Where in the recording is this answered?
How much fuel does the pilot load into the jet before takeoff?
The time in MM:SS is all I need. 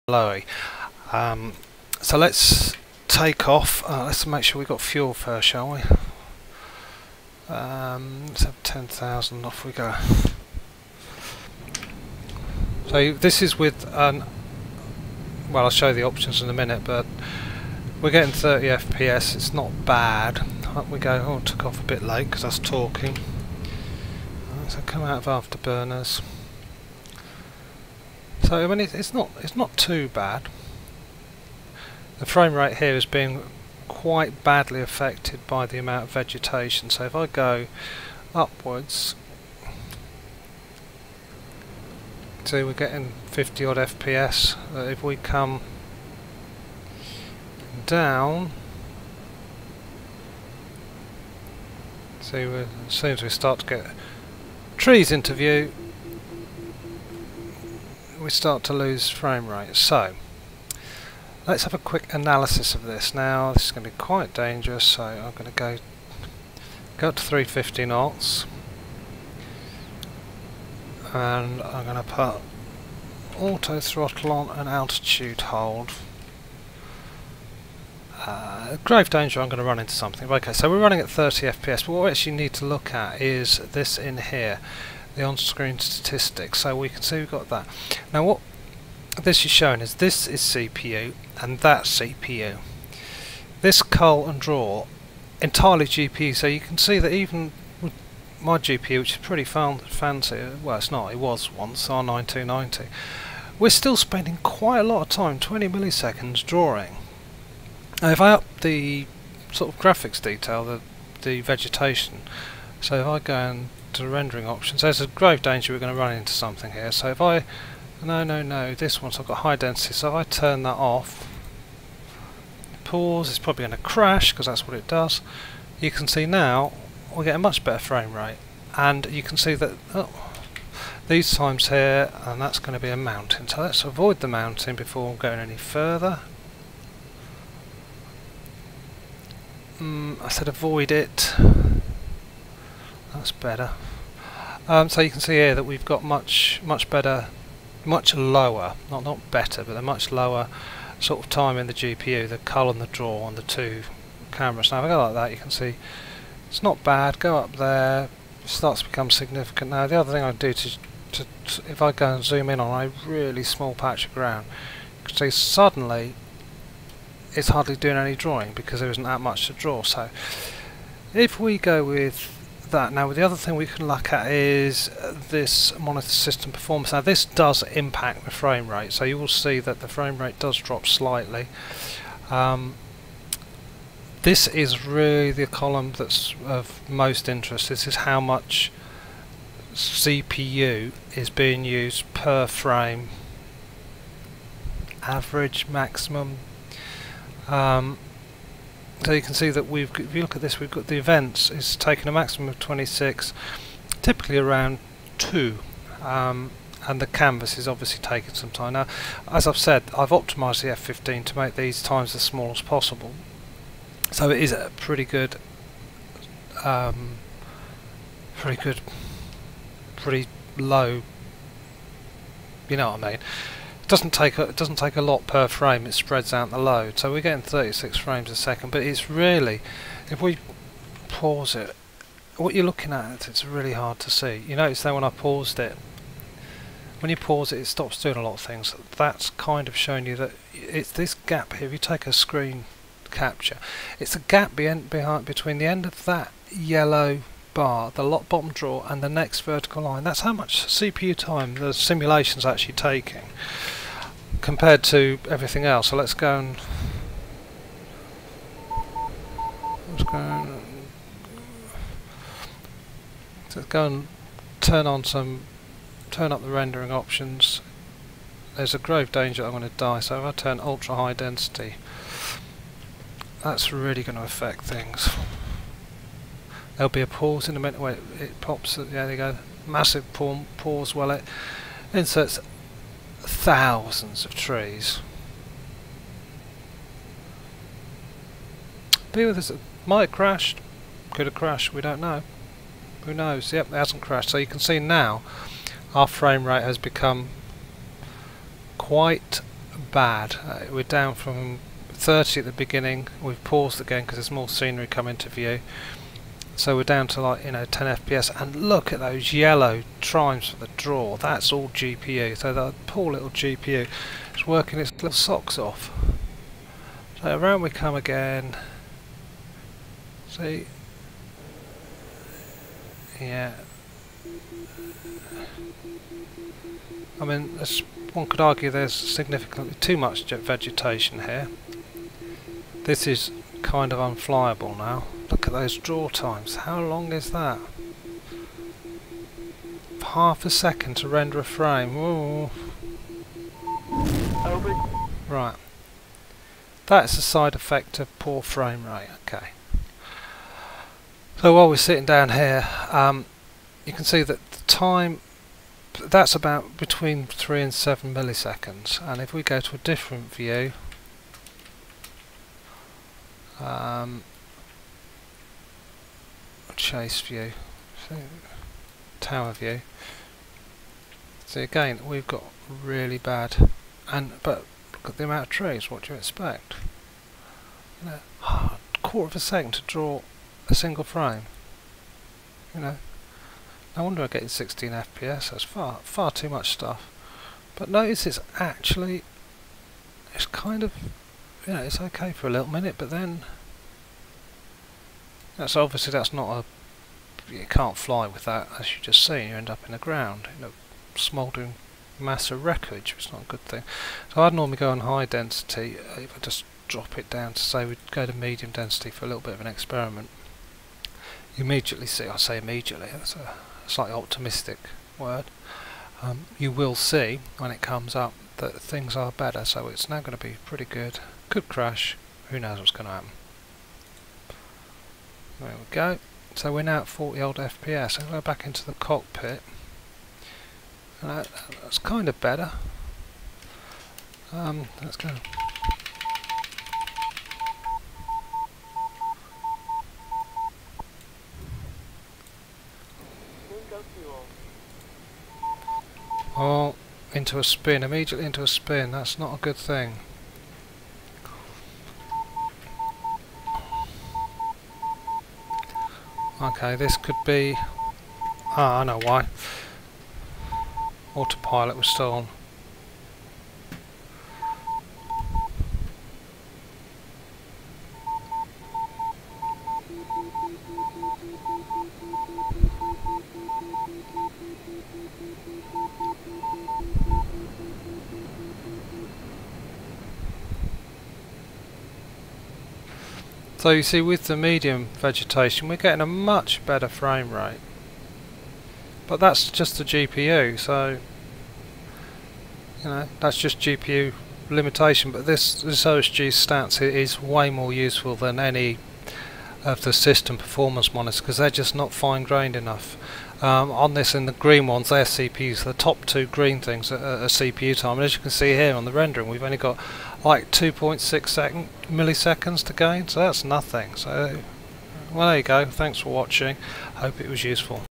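00:08.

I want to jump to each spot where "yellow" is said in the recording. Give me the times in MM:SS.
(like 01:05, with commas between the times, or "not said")
04:06, 05:09.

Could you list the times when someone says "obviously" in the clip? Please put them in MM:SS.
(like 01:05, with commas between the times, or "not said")
03:27, 06:35.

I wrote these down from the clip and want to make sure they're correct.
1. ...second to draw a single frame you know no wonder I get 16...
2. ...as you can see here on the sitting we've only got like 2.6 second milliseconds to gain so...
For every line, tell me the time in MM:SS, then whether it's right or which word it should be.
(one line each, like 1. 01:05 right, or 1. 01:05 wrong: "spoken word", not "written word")
1. 06:19 right
2. 08:28 wrong: "rendering", not "sitting".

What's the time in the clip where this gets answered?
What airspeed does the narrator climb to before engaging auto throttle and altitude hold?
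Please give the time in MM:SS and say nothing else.
01:07.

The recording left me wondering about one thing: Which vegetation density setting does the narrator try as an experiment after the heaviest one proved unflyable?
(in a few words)
medium density.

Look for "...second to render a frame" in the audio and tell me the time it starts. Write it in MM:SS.
05:40.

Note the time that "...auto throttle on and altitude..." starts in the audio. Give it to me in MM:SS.
01:13.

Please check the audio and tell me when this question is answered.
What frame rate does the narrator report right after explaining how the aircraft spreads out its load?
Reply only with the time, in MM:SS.
03:47.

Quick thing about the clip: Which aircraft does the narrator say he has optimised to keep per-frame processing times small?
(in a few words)
F15.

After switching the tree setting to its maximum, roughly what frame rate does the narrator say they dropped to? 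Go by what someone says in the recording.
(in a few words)
10 FPS.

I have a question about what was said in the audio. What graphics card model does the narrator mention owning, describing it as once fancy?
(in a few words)
R9 290.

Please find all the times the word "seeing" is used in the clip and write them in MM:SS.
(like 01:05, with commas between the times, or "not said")
not said.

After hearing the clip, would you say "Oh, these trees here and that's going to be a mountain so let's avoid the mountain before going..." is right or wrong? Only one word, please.
wrong.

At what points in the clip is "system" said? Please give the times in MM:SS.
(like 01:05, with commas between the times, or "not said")
02:56, 08:20.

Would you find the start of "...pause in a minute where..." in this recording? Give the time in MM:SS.
04:37.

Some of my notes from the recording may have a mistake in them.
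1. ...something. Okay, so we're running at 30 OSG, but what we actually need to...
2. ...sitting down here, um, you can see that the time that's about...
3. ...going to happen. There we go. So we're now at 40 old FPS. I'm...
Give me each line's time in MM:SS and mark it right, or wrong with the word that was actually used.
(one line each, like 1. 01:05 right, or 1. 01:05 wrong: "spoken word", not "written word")
1. 01:19 wrong: "FPS", not "OSG"
2. 05:51 right
3. 07:02 right.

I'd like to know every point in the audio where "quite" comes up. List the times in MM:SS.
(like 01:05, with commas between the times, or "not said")
00:33, 01:03, 01:44, 04:58.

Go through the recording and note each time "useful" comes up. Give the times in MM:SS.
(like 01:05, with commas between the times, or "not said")
08:17, 08:37.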